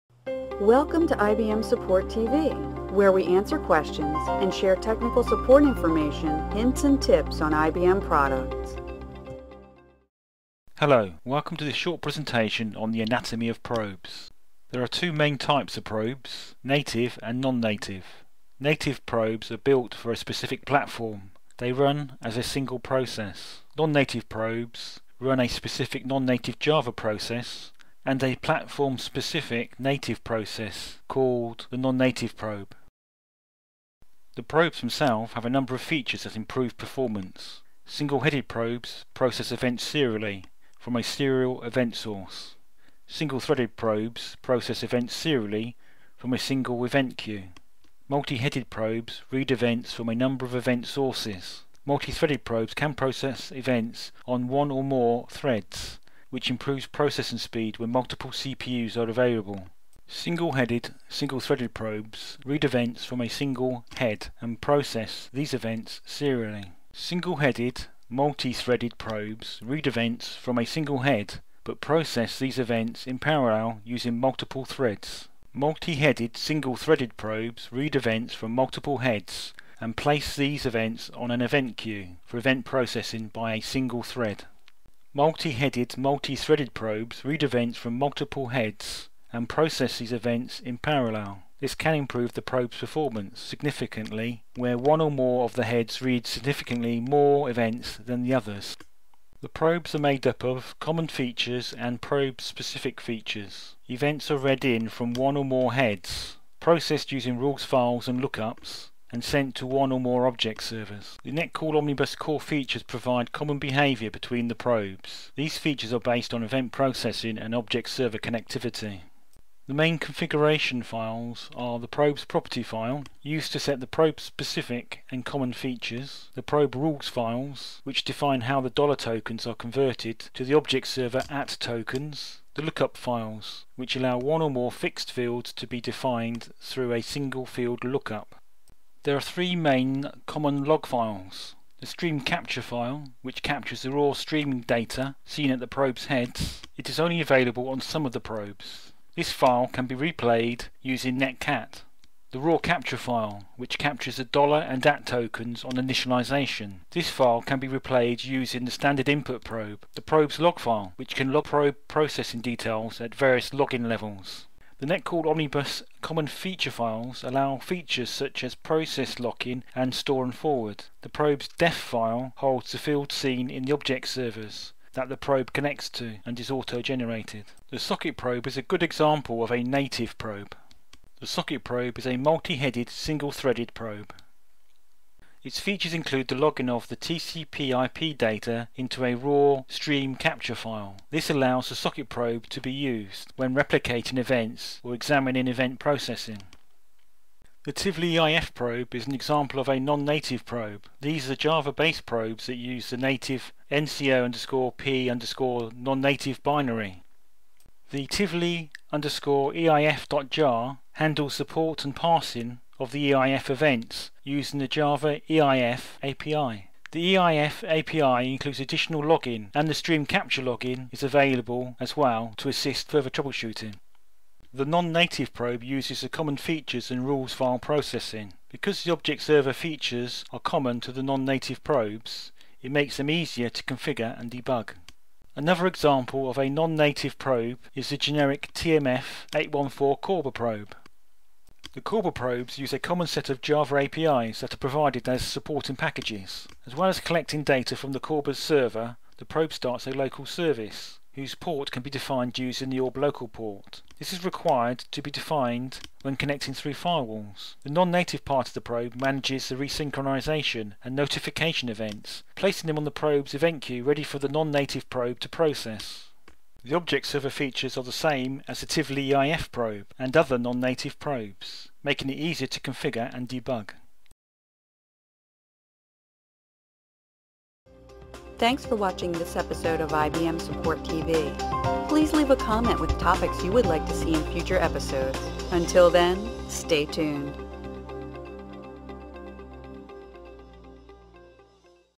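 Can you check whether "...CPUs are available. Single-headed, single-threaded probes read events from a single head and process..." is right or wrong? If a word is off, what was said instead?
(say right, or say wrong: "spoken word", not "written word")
right.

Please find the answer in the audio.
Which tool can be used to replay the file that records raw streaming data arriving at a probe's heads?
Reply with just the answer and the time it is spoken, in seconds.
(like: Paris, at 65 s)
netcat, at 151 s.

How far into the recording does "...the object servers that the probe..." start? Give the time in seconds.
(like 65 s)
173 s.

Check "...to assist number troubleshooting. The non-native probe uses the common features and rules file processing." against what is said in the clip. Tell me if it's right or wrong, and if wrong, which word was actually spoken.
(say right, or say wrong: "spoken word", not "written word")
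wrong: "further", not "number".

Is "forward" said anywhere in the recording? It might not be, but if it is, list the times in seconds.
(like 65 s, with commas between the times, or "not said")
170 s.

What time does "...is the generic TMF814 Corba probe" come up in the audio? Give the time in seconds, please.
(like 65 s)
237 s.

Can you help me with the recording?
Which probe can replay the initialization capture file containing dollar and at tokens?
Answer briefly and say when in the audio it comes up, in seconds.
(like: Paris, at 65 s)
standard input probe, at 158 s.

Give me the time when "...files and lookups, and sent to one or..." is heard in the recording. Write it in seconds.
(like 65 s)
107 s.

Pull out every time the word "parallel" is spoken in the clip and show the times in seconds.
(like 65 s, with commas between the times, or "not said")
73 s, 90 s.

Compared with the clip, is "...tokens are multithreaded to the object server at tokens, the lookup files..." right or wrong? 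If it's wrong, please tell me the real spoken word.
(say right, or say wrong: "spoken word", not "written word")
wrong: "converted", not "multithreaded".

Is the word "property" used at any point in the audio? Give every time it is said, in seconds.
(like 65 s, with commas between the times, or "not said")
122 s.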